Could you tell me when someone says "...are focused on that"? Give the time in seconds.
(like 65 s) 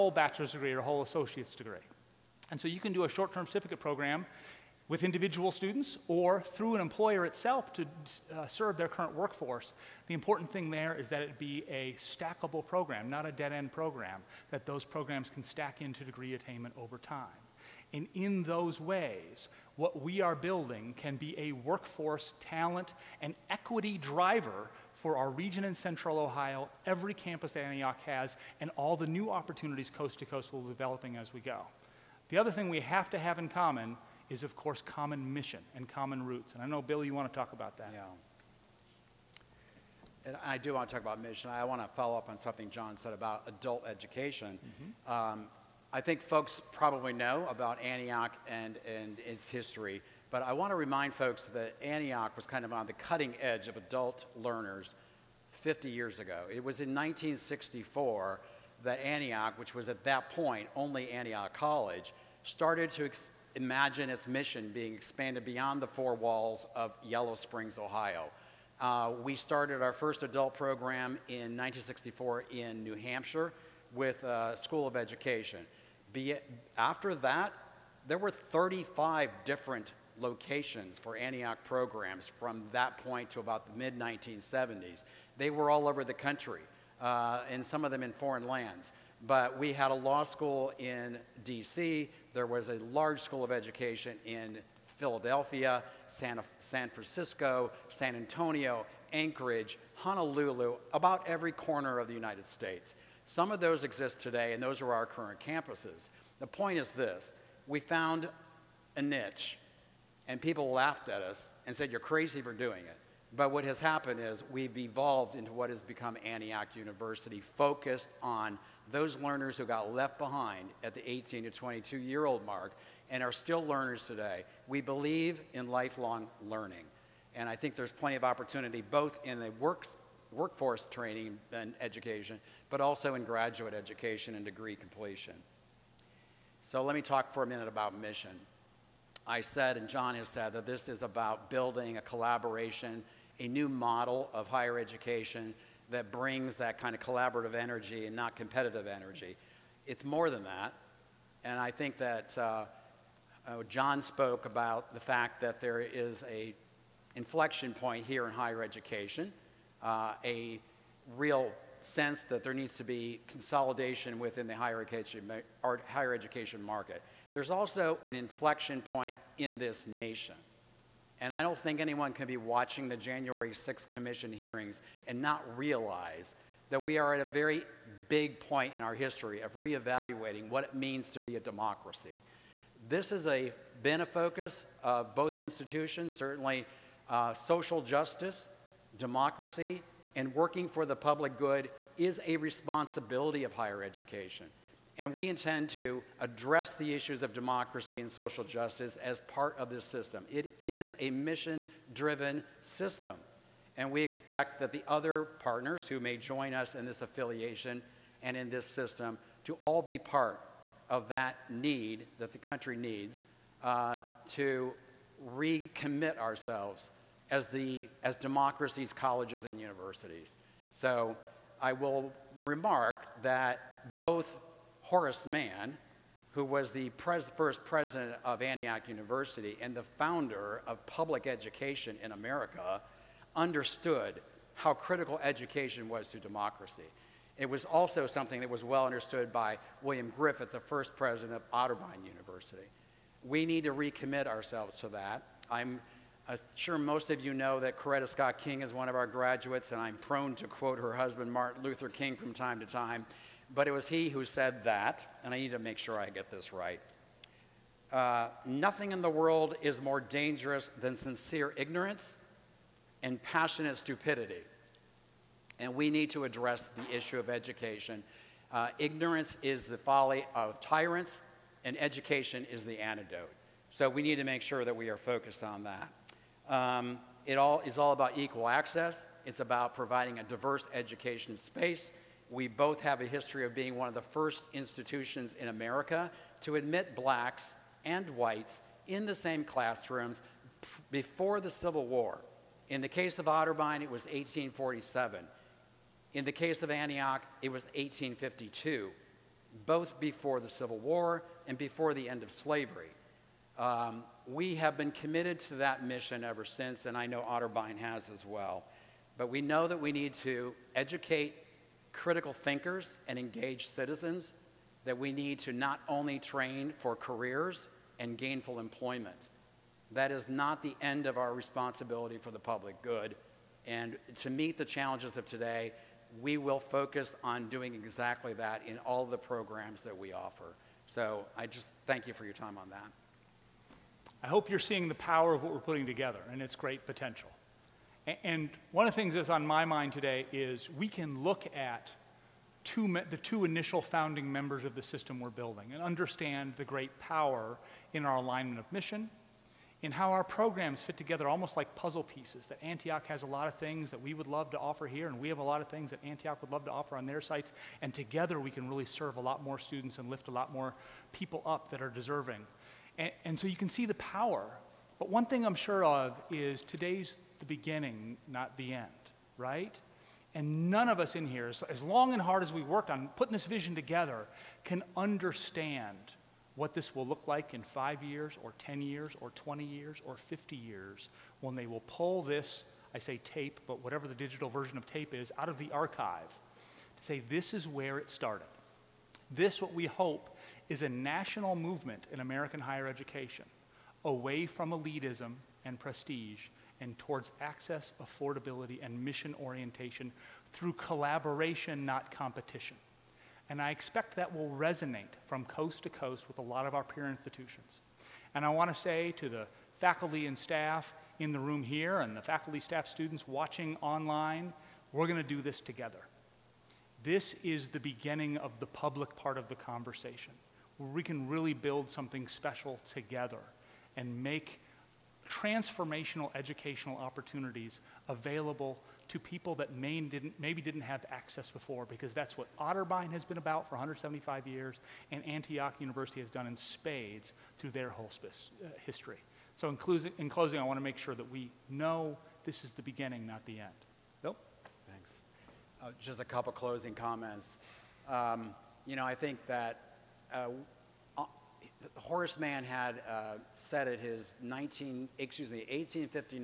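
274 s.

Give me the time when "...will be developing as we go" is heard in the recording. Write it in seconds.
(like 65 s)
30 s.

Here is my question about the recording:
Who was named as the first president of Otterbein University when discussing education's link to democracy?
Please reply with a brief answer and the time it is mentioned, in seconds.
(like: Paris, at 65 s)
William Griffith, at 239 s.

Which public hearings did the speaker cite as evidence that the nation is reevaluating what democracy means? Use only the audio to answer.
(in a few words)
January 6th Commission hearings.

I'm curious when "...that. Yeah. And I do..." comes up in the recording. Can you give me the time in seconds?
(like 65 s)
37 s.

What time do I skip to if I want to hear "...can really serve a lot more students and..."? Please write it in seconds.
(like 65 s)
358 s.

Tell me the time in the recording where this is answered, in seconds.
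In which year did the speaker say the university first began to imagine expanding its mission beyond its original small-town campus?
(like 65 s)
56 s.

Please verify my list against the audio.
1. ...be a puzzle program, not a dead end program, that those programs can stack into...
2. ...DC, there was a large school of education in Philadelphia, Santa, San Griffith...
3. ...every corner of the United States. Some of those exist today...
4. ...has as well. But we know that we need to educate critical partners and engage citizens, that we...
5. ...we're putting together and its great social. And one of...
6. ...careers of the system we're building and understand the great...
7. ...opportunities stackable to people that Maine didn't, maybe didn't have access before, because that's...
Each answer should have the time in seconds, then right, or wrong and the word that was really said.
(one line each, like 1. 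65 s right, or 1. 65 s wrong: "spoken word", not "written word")
1. 11 s wrong: "stackable", not "puzzle"
2. 91 s wrong: "Francisco", not "Griffith"
3. 101 s right
4. 307 s wrong: "thinkers", not "partners"
5. 335 s wrong: "potential", not "social"
6. 344 s wrong: "members", not "careers"
7. 426 s wrong: "available", not "stackable".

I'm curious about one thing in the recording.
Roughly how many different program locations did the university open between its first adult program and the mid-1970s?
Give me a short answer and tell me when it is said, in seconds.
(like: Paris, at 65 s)
35, at 78 s.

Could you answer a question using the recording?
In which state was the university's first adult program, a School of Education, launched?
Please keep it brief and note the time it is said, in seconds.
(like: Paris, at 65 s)
New Hampshire, at 72 s.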